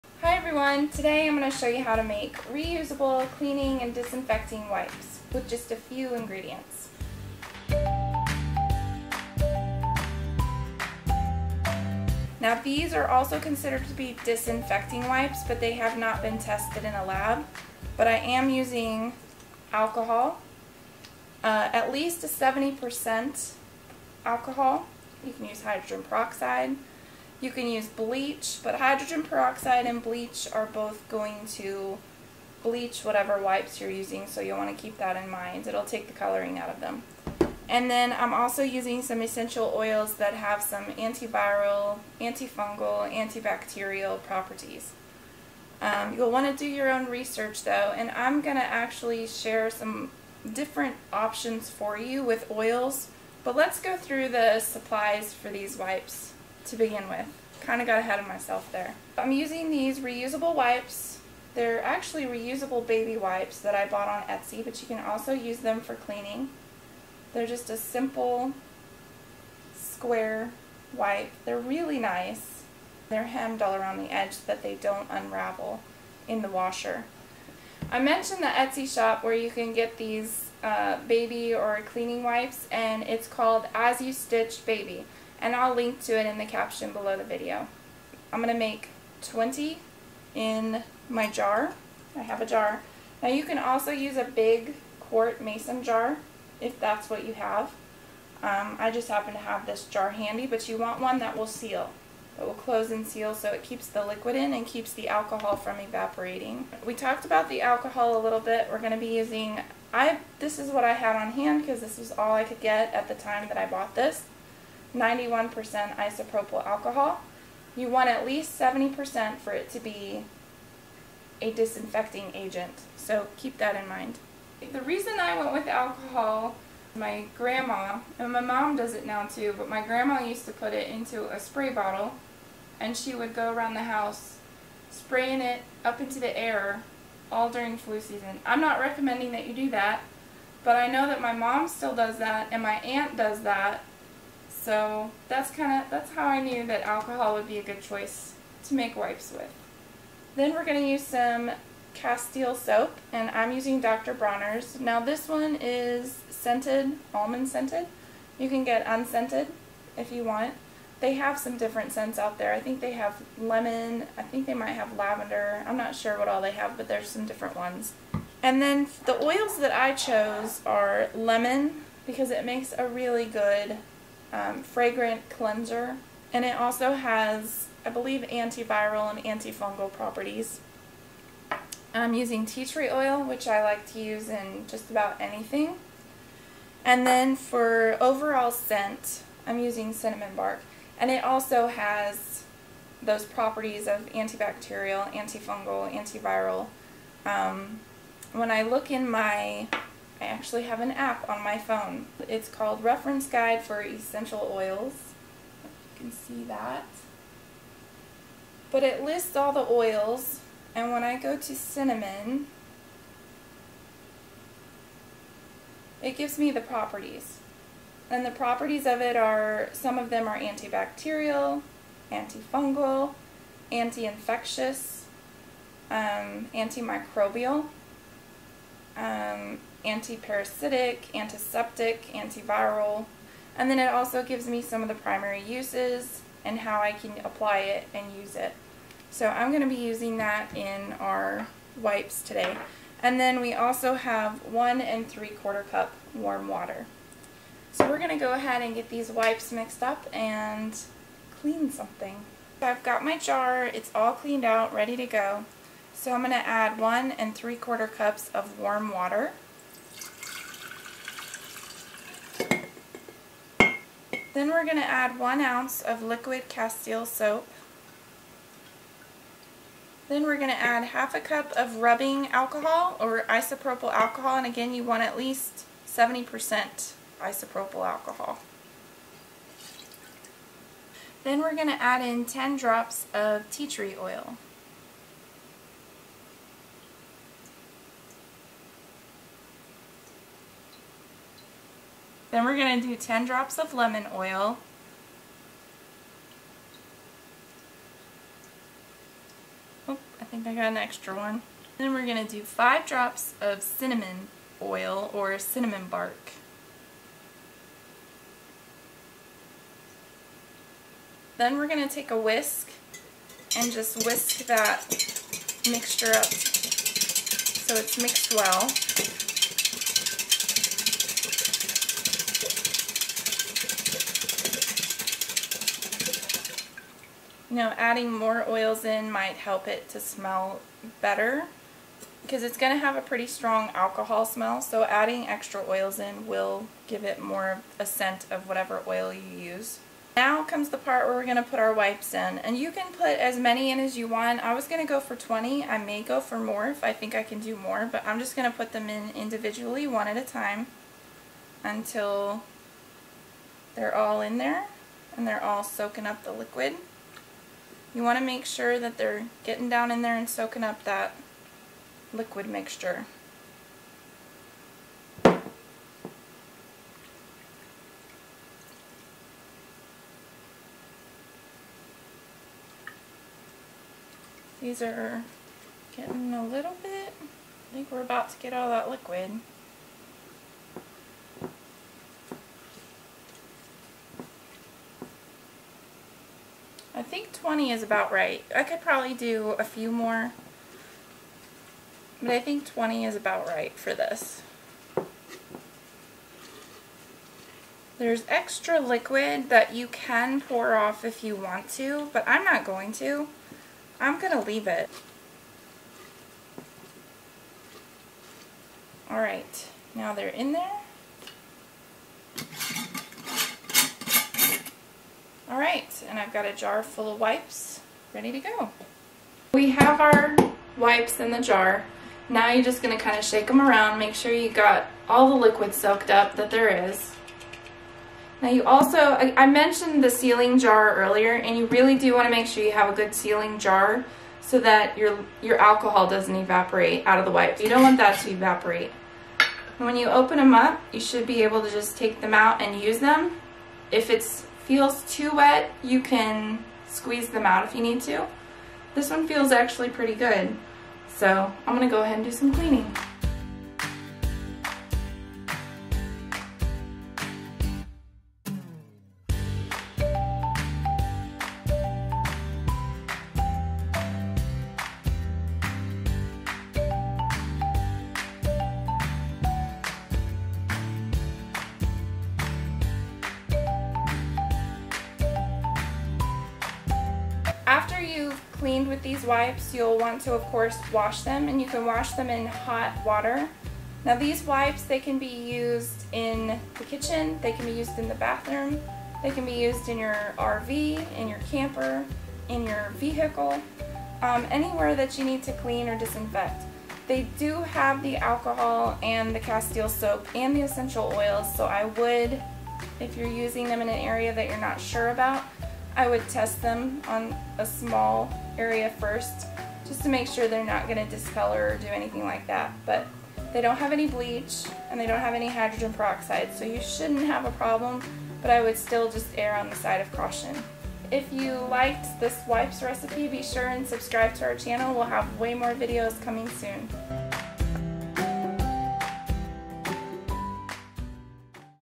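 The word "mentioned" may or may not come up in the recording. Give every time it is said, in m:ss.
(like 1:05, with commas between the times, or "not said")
1:17, 7:09.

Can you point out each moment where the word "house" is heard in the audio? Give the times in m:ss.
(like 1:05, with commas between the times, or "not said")
2:13.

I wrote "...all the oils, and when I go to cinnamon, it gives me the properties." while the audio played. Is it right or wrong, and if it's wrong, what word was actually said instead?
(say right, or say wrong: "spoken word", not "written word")
right.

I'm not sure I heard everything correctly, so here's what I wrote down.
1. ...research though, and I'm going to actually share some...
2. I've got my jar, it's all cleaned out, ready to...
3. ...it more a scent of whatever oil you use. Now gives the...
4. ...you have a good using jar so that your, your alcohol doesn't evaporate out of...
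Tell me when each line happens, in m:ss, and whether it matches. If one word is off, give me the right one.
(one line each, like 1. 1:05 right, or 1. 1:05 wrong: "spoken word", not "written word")
1. 0:47 right
2. 4:12 right
3. 5:37 wrong: "comes", not "gives"
4. 7:12 wrong: "sealing", not "using".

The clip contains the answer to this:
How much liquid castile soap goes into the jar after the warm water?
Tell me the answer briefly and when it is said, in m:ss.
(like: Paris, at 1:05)
1 ounce, at 4:25.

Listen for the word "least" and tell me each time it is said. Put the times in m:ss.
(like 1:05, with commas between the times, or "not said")
0:21, 1:58, 4:35.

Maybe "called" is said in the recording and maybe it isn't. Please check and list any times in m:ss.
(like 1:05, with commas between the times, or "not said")
1:23, 3:22.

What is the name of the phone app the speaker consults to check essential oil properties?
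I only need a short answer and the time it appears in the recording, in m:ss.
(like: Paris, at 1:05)
Reference Guide for Essential Oils, at 3:22.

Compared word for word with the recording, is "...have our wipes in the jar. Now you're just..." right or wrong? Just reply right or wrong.
right.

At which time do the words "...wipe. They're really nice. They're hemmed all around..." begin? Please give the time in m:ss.
1:10.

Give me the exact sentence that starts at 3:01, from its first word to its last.
I'm using tea tree oil, which I like to use in just about anything.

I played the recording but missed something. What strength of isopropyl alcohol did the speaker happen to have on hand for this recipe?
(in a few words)
91%.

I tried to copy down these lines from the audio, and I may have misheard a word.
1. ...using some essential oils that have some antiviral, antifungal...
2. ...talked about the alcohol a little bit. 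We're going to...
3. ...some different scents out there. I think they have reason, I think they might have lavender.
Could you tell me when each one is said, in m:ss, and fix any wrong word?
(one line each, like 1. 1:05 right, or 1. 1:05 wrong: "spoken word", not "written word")
1. 0:38 right
2. 1:46 right
3. 2:41 wrong: "lemon", not "reason".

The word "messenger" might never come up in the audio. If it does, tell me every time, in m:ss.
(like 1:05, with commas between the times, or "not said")
not said.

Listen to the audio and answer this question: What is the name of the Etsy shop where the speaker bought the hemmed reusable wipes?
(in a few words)
As You Stitch Baby.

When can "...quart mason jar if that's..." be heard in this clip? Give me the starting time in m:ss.
1:34.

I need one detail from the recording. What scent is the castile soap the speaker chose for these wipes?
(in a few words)
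almond.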